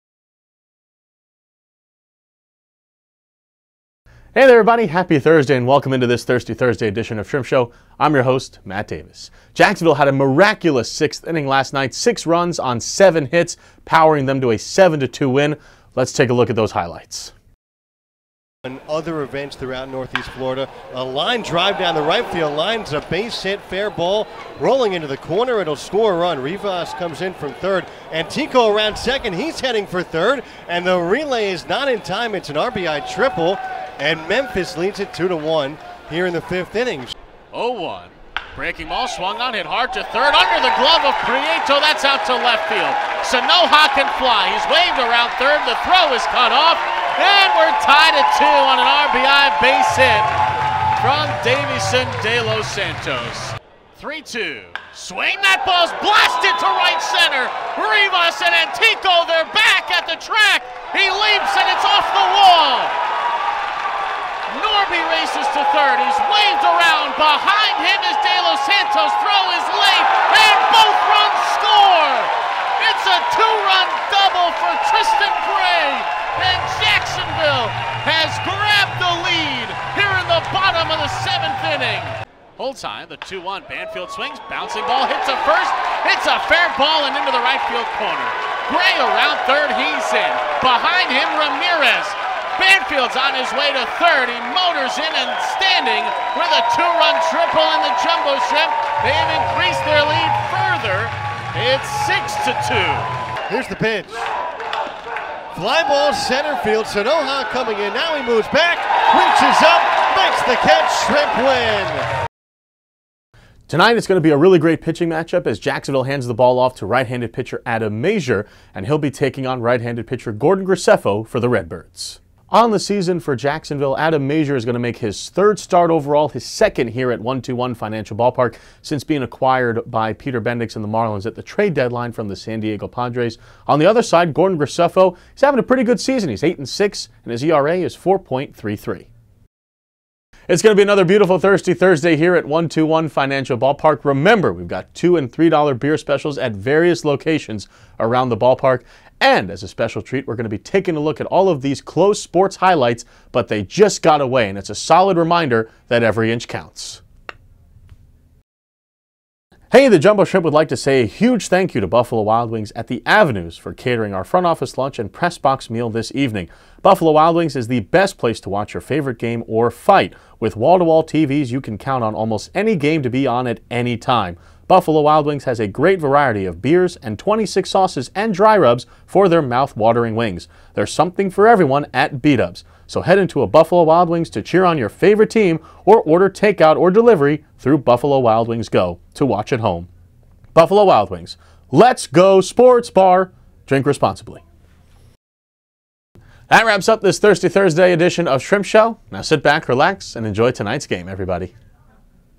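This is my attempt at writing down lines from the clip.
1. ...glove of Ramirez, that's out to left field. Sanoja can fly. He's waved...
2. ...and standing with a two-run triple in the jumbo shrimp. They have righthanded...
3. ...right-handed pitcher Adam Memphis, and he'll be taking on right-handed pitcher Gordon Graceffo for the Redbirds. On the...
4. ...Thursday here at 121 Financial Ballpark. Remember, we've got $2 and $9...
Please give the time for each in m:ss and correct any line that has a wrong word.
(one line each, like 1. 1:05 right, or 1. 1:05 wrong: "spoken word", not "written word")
1. 0:40 wrong: "Prieto", not "Ramirez"
2. 1:35 wrong: "increased", not "righthanded"
3. 1:56 wrong: "Mazur", not "Memphis"
4. 2:21 wrong: "3", not "9".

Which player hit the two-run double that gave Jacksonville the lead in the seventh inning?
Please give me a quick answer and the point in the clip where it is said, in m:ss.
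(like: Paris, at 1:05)
Tristan Gray, at 1:14.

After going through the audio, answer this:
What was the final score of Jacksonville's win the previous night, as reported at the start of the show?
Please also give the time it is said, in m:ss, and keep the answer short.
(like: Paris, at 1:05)
7-2, at 0:14.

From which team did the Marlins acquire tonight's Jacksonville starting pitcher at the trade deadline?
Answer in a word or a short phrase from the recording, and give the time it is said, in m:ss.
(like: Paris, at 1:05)
San Diego Padres, at 2:12.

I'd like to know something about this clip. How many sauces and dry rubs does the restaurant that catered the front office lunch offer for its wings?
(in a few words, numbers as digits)
26.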